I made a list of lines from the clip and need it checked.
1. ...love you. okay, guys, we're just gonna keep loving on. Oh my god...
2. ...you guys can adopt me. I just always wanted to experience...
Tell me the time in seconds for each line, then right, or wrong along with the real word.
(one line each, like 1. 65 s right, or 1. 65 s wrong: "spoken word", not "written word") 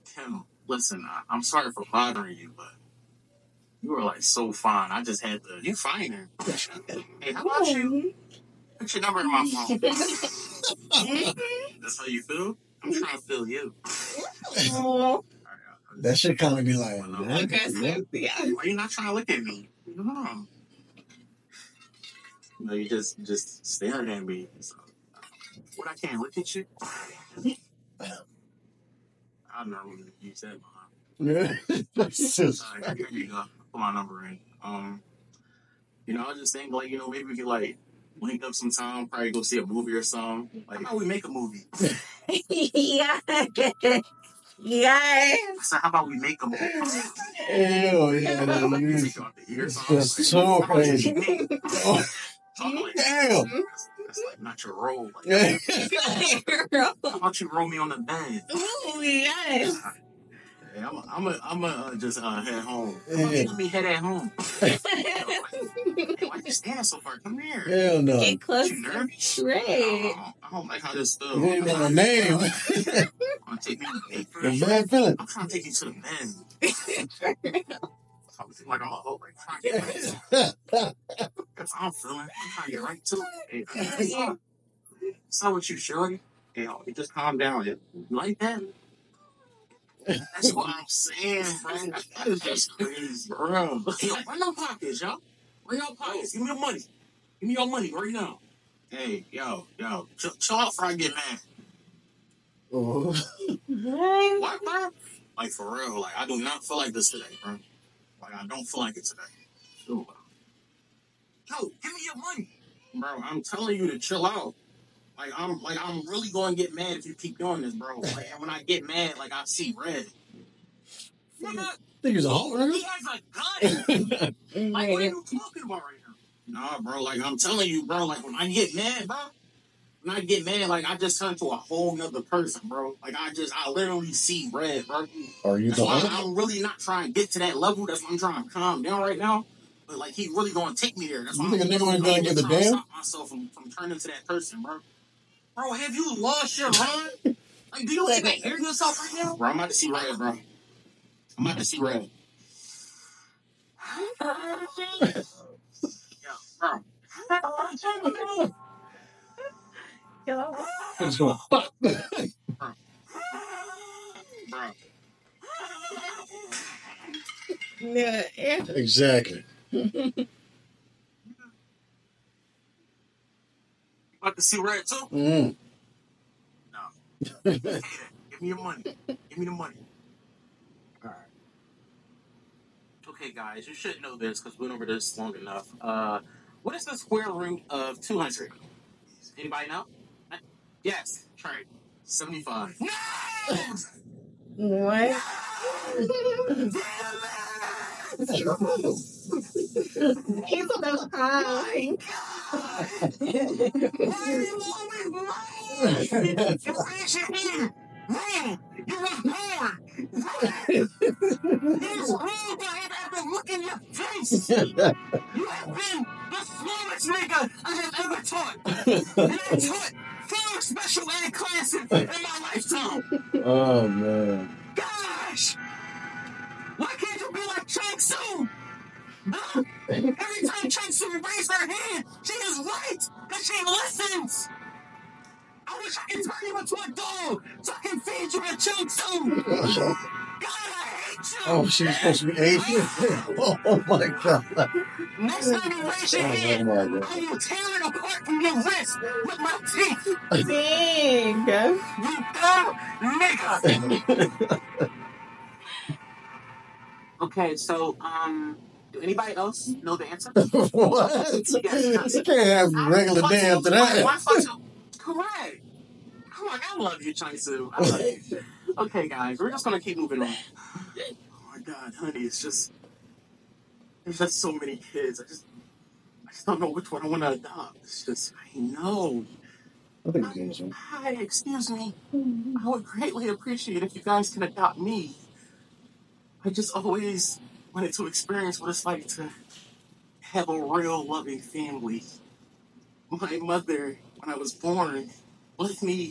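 1. 267 s wrong: "moving", not "loving"
2. 283 s right.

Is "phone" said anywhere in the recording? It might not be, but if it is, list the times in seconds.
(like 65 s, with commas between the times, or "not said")
9 s.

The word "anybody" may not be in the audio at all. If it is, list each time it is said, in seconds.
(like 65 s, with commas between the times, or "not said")
189 s, 259 s.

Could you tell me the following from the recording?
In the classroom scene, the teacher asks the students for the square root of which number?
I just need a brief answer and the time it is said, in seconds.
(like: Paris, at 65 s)
200, at 187 s.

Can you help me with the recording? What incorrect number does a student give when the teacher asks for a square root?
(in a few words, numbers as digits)
75.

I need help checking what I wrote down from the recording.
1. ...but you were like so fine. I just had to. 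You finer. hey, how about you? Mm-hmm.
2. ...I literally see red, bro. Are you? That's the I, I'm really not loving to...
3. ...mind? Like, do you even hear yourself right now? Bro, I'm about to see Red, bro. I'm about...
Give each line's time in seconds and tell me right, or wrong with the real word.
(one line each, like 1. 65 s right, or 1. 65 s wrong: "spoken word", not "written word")
1. 2 s right
2. 133 s wrong: "trying", not "loving"
3. 146 s right.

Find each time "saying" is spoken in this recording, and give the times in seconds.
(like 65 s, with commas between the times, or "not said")
90 s.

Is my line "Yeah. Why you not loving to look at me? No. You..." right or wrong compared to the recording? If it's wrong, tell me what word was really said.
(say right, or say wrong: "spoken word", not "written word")
wrong: "trying", not "loving".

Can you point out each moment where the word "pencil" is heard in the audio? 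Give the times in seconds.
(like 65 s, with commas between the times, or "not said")
not said.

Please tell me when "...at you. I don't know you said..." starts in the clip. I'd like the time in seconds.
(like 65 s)
26 s.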